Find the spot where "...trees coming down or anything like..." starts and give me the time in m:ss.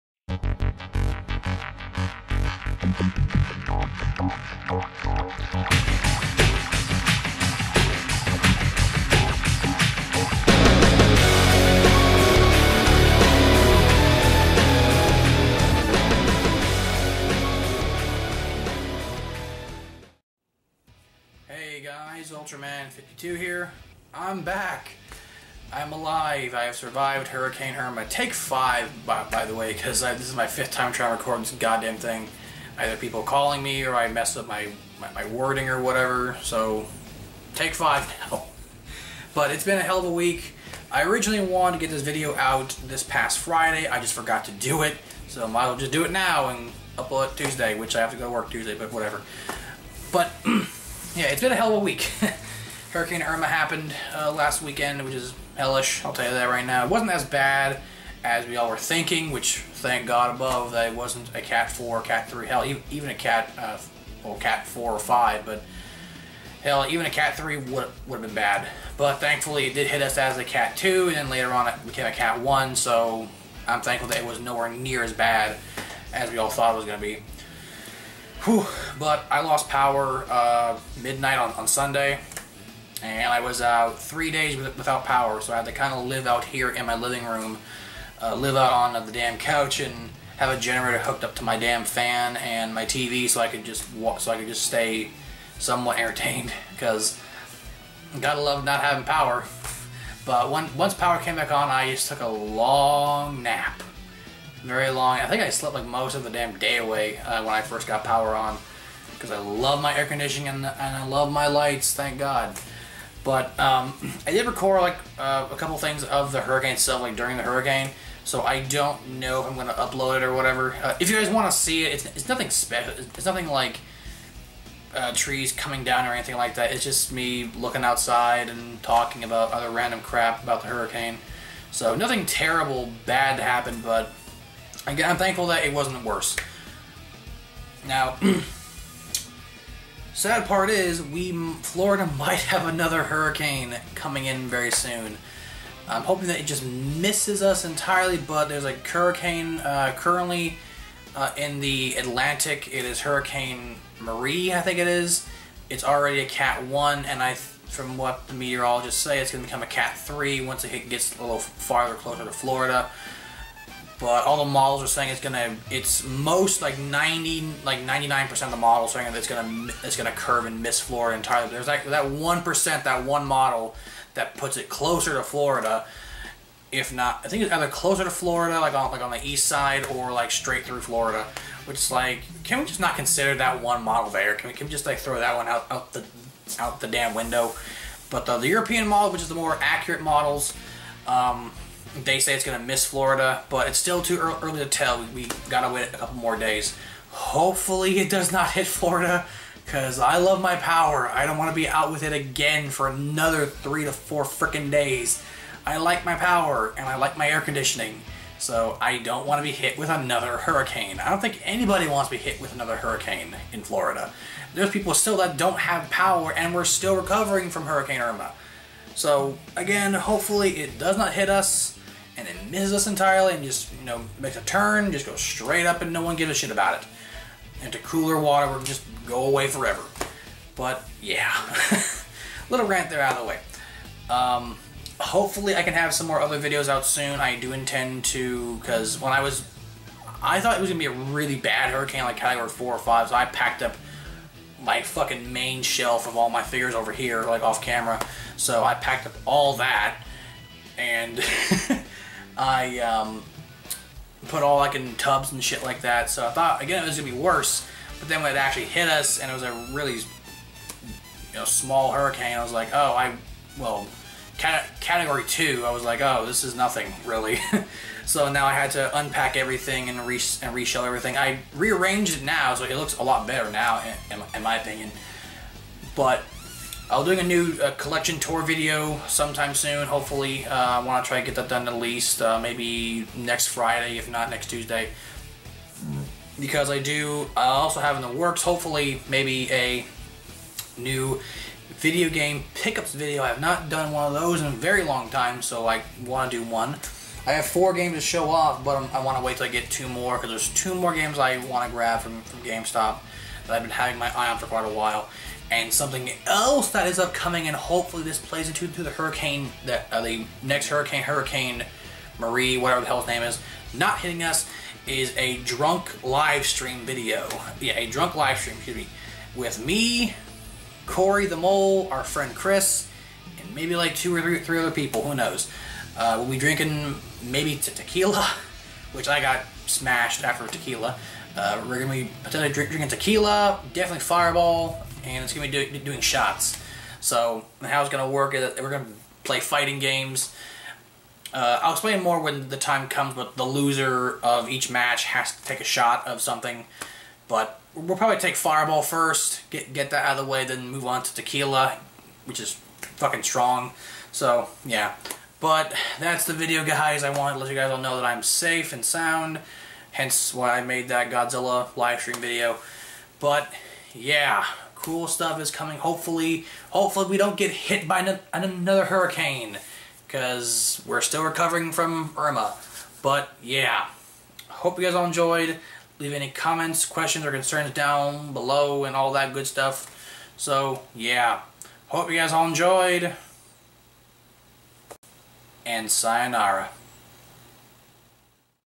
2:05.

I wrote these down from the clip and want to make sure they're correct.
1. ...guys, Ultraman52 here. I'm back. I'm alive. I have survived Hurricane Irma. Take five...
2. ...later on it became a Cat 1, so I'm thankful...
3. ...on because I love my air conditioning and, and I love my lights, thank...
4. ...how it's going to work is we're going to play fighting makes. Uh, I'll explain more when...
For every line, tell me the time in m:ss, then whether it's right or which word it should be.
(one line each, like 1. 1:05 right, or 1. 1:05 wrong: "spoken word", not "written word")
1. 0:21 right
2. 1:11 right
3. 1:48 right
4. 5:37 wrong: "games", not "makes".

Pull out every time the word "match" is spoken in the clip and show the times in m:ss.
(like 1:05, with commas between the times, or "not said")
5:44.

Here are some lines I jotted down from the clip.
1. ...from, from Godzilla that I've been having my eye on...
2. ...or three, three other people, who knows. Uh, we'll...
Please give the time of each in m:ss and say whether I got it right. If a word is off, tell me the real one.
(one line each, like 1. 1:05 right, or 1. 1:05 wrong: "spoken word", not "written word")
1. 5:02 wrong: "GameStop", not "Godzilla"
2. 5:24 right.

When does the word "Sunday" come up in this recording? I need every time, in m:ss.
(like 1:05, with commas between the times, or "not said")
1:21.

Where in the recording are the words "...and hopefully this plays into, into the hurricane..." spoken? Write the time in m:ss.
5:07.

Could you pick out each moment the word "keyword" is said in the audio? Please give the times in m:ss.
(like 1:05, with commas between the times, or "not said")
not said.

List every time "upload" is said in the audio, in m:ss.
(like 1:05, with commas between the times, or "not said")
0:46, 1:59.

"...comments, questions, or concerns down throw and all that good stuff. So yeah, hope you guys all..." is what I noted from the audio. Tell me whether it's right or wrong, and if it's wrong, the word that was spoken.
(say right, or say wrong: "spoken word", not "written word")
wrong: "below", not "throw".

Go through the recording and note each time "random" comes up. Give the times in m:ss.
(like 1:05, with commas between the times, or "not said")
2:09.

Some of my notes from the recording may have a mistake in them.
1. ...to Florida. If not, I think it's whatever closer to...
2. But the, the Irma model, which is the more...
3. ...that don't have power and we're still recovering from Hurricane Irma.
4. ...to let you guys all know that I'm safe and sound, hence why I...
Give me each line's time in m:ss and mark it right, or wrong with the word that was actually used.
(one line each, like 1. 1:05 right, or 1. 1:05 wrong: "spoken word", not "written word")
1. 2:55 wrong: "either", not "whatever"
2. 3:08 wrong: "European", not "Irma"
3. 3:35 right
4. 5:57 right.